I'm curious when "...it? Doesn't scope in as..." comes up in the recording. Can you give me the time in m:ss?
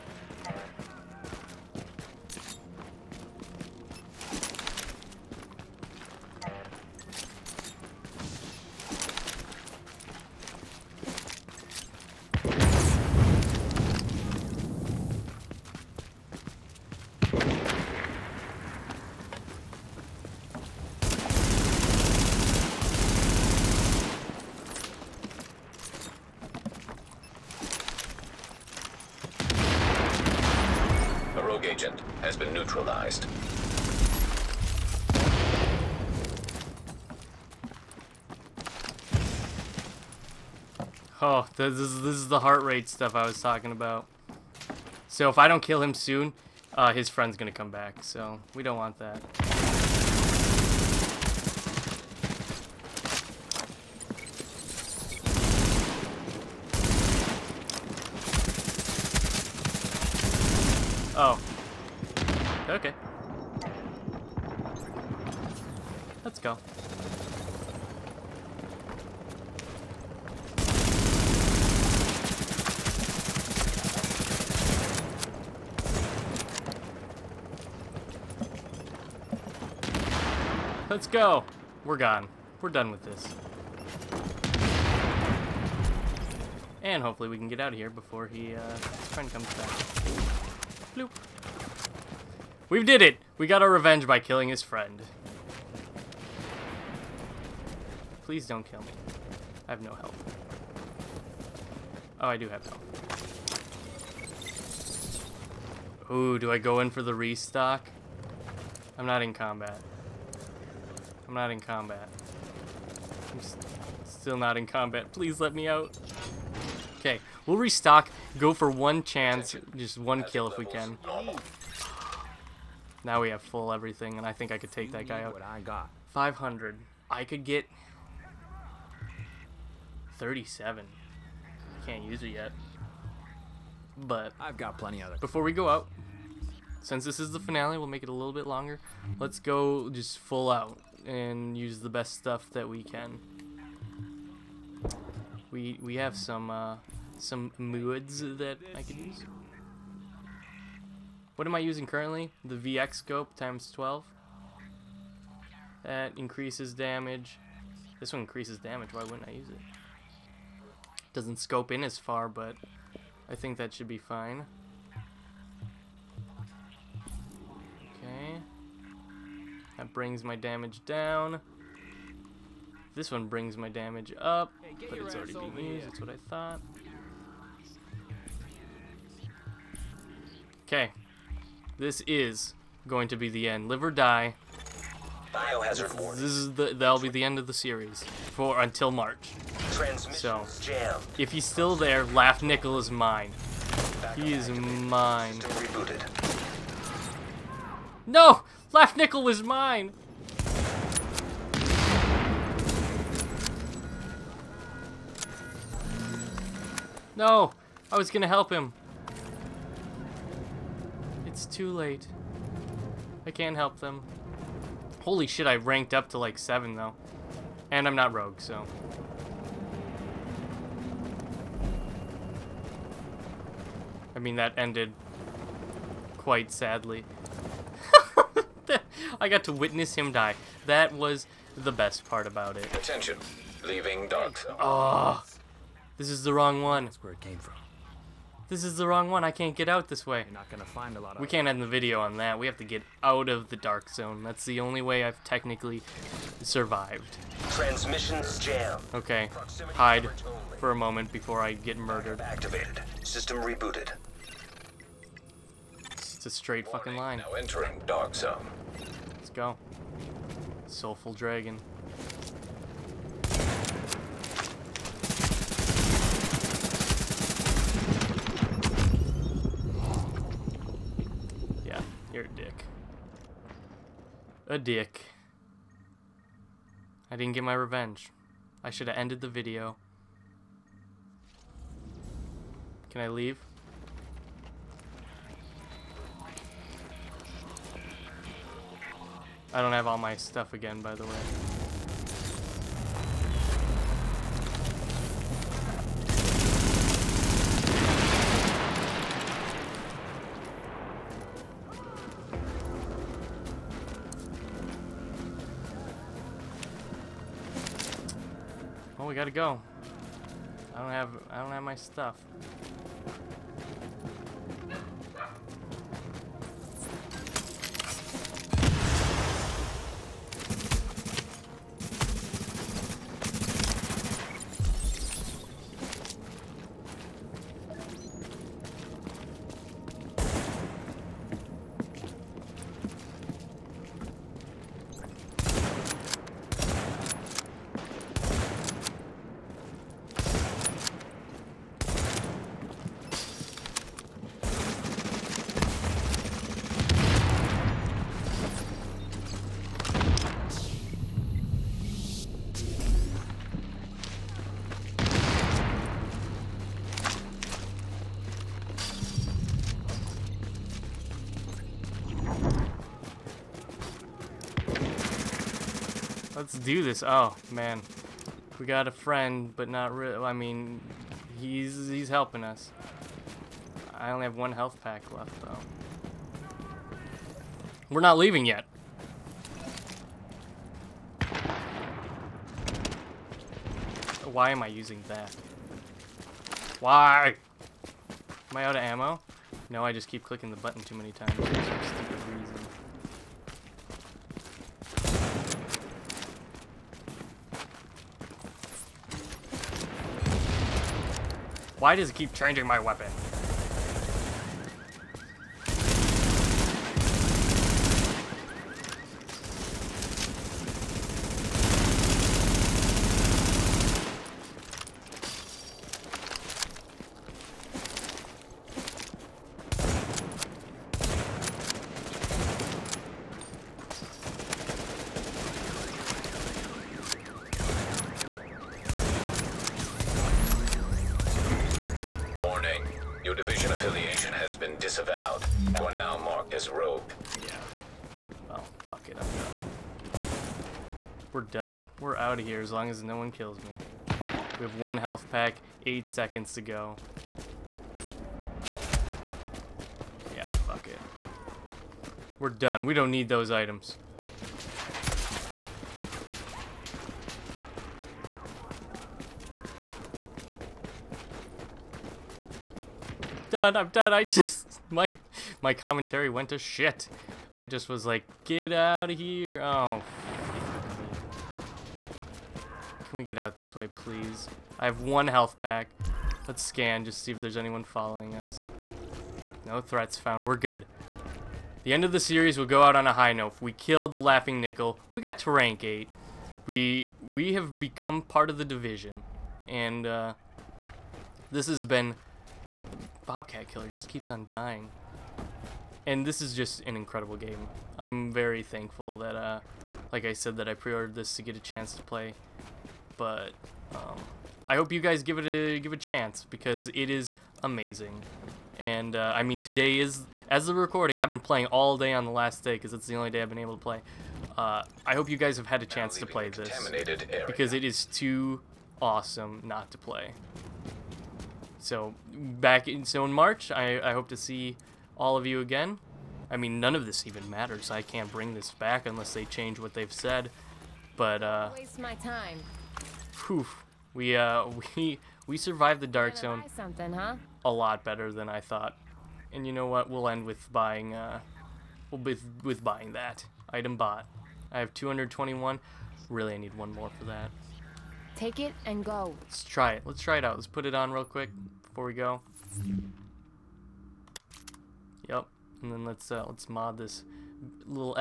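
2:39.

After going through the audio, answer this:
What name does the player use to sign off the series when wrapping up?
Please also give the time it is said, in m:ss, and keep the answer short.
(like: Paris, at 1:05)
Bobcat Killer, at 8:13.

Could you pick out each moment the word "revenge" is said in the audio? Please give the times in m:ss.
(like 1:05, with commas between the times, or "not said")
1:33, 4:37.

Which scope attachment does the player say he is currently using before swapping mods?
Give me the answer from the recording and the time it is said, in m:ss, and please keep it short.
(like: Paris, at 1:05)
VX scope, at 2:32.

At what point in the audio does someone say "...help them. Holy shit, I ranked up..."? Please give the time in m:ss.
3:33.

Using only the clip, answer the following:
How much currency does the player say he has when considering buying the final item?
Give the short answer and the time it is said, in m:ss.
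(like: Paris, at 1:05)
221, at 9:04.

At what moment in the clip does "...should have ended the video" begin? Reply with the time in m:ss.
4:38.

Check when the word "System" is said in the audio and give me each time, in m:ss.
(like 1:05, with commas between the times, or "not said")
4:13.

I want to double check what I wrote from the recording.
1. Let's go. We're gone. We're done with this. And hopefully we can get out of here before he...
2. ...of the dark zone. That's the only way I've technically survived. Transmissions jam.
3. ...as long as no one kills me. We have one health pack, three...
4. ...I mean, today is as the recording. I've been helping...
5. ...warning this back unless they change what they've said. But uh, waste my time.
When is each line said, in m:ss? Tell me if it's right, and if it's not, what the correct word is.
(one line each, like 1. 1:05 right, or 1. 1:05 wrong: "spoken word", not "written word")
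1. 1:20 right
2. 4:03 right
3. 7:22 wrong: "eight", not "three"
4. 8:29 wrong: "playing", not "helping"
5. 8:48 wrong: "bring", not "warning".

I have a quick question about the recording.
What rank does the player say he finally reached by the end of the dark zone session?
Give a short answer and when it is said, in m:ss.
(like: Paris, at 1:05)
8, at 8:05.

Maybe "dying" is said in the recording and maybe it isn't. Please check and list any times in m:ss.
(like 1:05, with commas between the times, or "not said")
8:14.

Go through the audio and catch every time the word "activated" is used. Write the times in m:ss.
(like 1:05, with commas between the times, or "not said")
3:14, 4:12.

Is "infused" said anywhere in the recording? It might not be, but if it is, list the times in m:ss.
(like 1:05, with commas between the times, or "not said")
not said.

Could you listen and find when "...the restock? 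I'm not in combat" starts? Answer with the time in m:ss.
1:47.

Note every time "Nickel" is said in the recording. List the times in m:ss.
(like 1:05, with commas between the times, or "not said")
3:12, 3:18, 8:04.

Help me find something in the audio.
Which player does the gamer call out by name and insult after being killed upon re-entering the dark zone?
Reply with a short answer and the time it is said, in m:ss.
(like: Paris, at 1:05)
Soulful dragon, at 4:20.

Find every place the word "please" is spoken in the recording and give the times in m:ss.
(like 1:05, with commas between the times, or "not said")
1:38, 1:55, 7:53.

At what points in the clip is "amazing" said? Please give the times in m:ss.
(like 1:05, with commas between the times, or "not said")
8:27.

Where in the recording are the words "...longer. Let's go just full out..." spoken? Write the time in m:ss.
2:18.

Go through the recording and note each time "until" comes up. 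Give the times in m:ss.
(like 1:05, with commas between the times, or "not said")
3:08.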